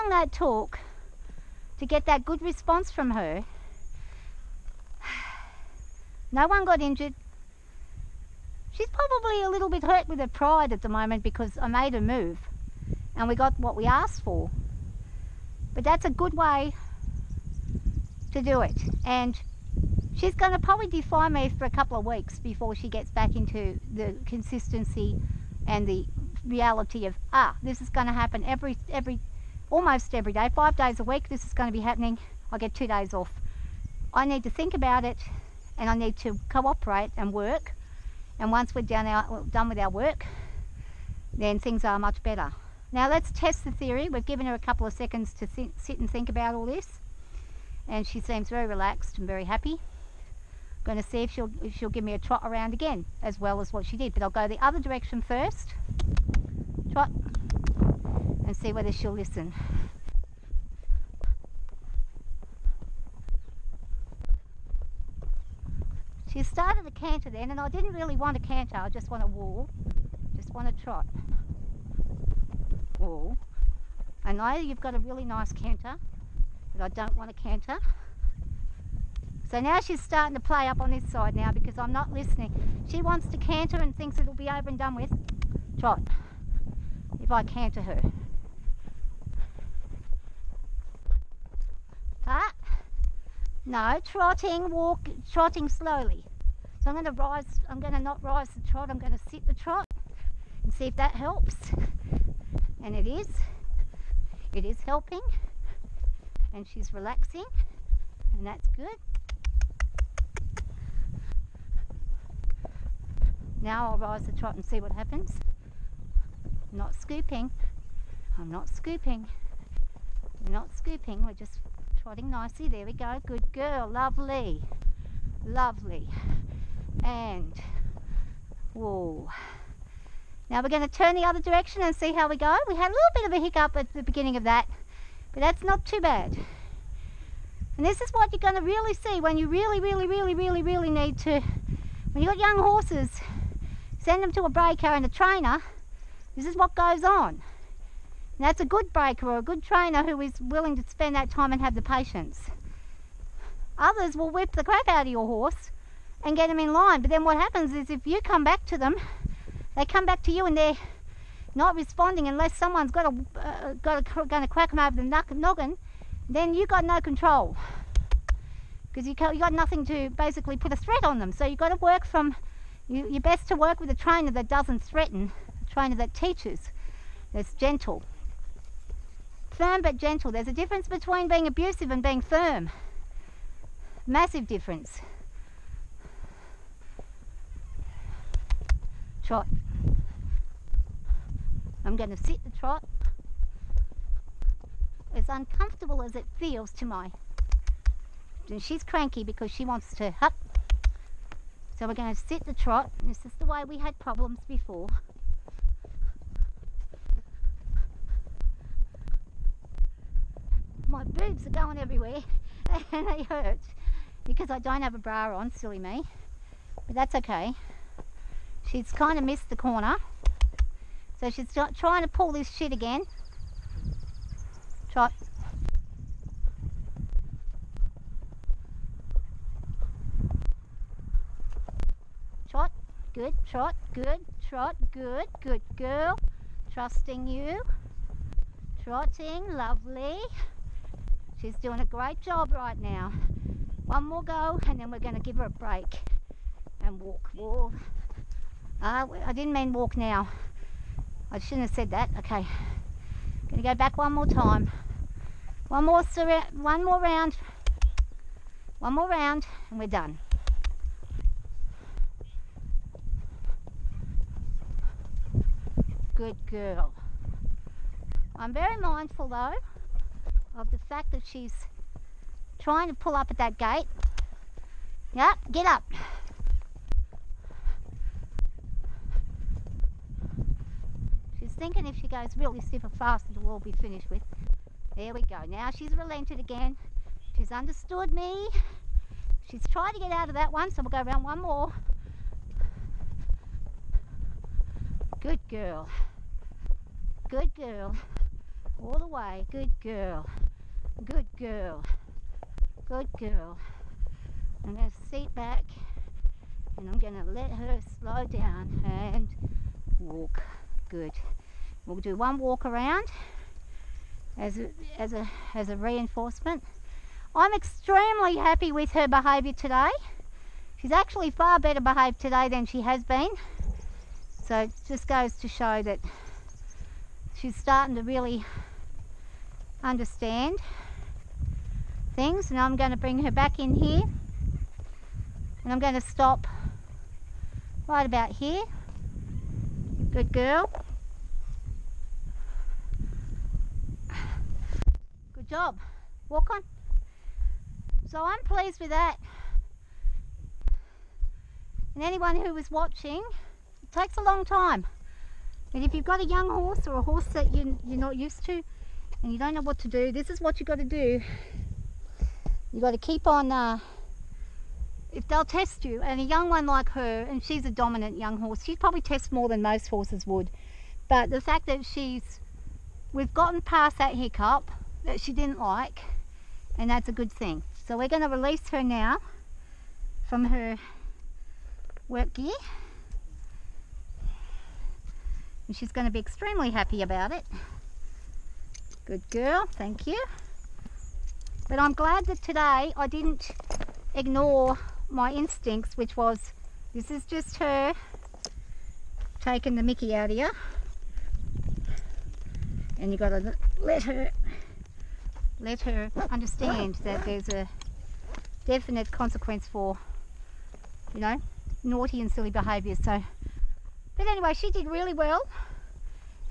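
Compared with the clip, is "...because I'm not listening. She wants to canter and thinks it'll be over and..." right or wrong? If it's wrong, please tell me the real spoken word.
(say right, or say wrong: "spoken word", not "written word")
right.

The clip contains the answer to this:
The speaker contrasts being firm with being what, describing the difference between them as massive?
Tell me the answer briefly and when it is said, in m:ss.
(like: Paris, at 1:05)
Abusive, at 3:01.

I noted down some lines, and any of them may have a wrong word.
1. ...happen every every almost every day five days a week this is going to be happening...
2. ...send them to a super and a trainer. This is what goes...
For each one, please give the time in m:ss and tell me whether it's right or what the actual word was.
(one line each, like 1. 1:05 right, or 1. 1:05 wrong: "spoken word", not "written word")
1. 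0:28 right
2. 2:23 wrong: "breaker", not "super".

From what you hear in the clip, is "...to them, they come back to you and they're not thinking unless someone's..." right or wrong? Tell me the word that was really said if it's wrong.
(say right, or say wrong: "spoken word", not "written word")
wrong: "responding", not "thinking".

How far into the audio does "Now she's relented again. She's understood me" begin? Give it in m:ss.
4:45.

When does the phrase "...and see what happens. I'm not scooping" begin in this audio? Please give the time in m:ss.
1:54.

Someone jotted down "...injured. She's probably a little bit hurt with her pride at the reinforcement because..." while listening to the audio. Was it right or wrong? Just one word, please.
wrong.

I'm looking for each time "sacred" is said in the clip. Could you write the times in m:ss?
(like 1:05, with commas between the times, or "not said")
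not said.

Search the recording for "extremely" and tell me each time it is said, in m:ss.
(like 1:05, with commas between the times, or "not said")
5:17, 6:26.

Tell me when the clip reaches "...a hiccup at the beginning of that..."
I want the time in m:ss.
2:13.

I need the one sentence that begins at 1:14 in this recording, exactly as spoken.
I know you've got a really nice canter, but I don't want a canter.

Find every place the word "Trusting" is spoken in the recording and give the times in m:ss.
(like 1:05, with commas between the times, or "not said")
3:56.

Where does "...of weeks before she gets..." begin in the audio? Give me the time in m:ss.
0:21.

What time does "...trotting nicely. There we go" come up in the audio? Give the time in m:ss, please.
2:02.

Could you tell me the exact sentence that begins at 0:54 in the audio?
But I'll go the other direction first, trot, and see whether she'll listen.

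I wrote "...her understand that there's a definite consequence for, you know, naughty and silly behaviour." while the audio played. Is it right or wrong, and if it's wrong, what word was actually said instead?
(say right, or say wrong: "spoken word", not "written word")
right.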